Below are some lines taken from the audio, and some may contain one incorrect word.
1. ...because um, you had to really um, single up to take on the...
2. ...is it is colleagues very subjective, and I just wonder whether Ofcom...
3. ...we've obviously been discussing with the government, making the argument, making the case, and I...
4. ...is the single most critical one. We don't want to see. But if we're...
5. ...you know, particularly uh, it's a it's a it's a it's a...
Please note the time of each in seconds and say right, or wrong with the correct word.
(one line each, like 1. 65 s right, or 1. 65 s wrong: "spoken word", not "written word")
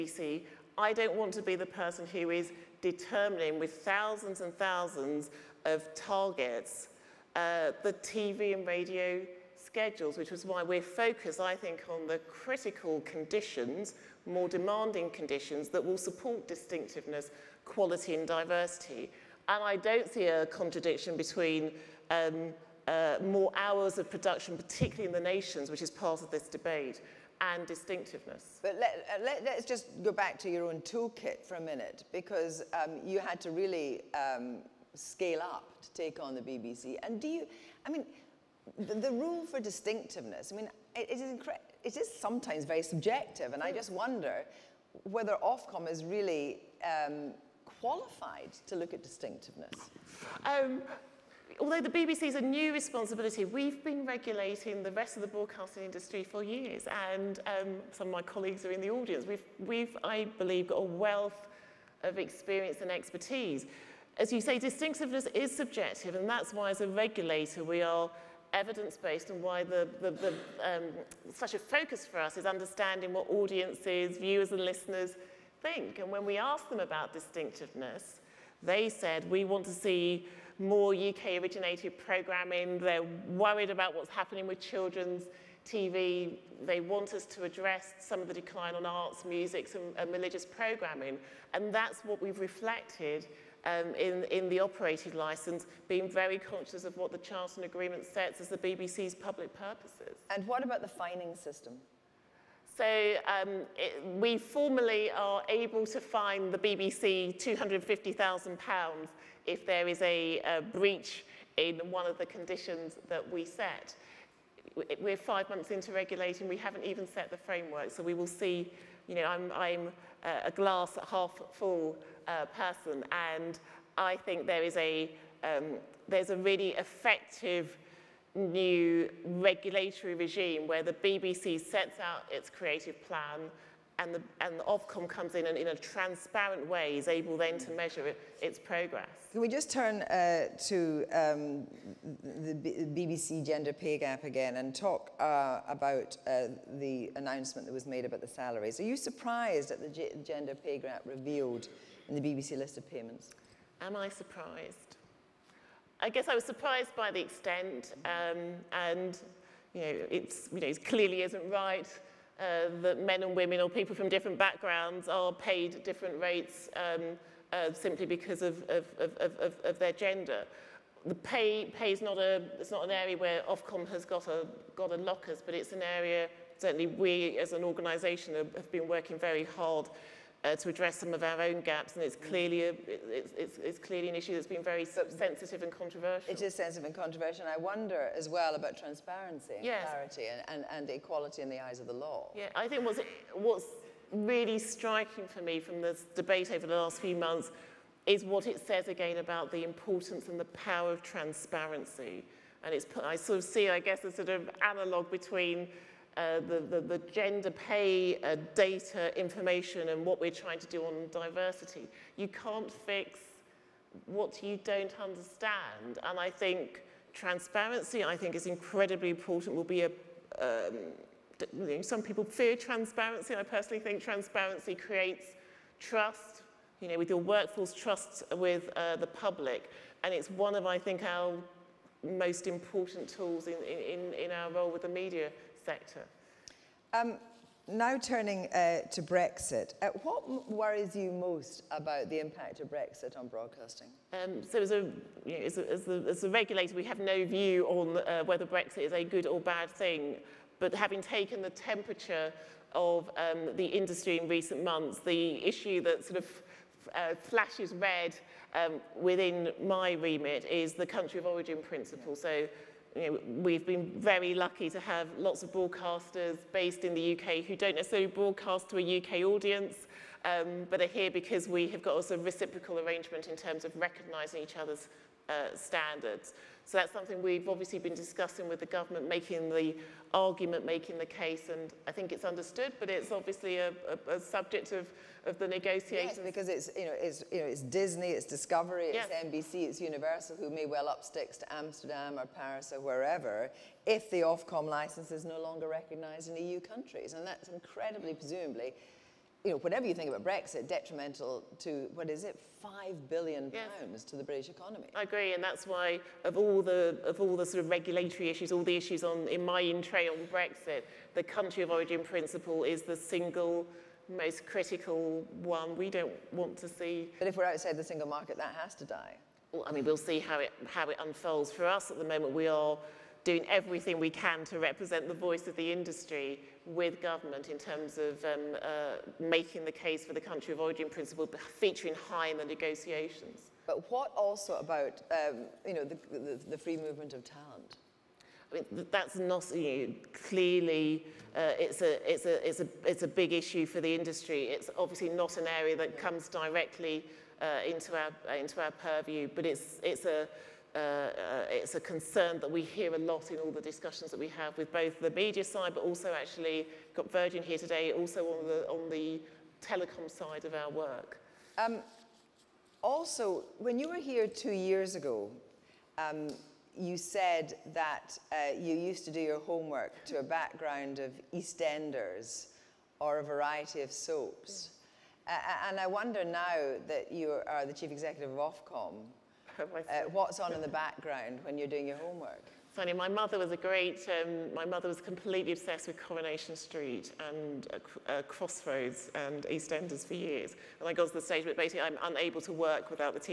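1. 32 s wrong: "scale", not "single"
2. 41 s wrong: "sometimes", not "colleagues"
3. 277 s right
4. 312 s right
5. 339 s wrong: "clearly", not "particularly".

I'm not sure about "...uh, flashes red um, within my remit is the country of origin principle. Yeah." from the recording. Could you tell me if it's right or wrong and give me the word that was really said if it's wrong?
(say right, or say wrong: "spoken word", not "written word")
right.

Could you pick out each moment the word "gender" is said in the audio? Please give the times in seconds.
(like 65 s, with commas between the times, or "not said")
143 s, 150 s, 169 s, 207 s.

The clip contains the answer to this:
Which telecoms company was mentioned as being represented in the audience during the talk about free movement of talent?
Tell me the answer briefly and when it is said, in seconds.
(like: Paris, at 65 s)
Virgin, at 357 s.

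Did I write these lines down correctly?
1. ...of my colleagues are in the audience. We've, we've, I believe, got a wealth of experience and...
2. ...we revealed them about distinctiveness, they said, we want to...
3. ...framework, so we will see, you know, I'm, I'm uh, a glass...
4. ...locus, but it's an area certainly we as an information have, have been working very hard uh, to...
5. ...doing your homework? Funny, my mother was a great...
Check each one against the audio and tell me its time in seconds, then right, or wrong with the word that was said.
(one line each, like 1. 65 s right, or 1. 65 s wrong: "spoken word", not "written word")
1. 58 s right
2. 76 s wrong: "asked", not "revealed"
3. 117 s right
4. 174 s wrong: "organisation", not "information"
5. 381 s right.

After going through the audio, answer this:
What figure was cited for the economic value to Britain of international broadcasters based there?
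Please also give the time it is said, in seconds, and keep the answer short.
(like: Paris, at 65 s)
5 billion pounds, at 302 s.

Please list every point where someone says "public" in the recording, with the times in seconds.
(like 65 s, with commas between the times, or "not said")
99 s, 229 s.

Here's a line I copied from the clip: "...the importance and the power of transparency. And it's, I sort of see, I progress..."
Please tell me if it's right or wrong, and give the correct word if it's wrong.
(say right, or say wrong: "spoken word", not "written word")
wrong: "guess", not "progress".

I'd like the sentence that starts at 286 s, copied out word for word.
Yes, because it's, you know, it's, you know, it's Disney, it's Discovery, it's yes.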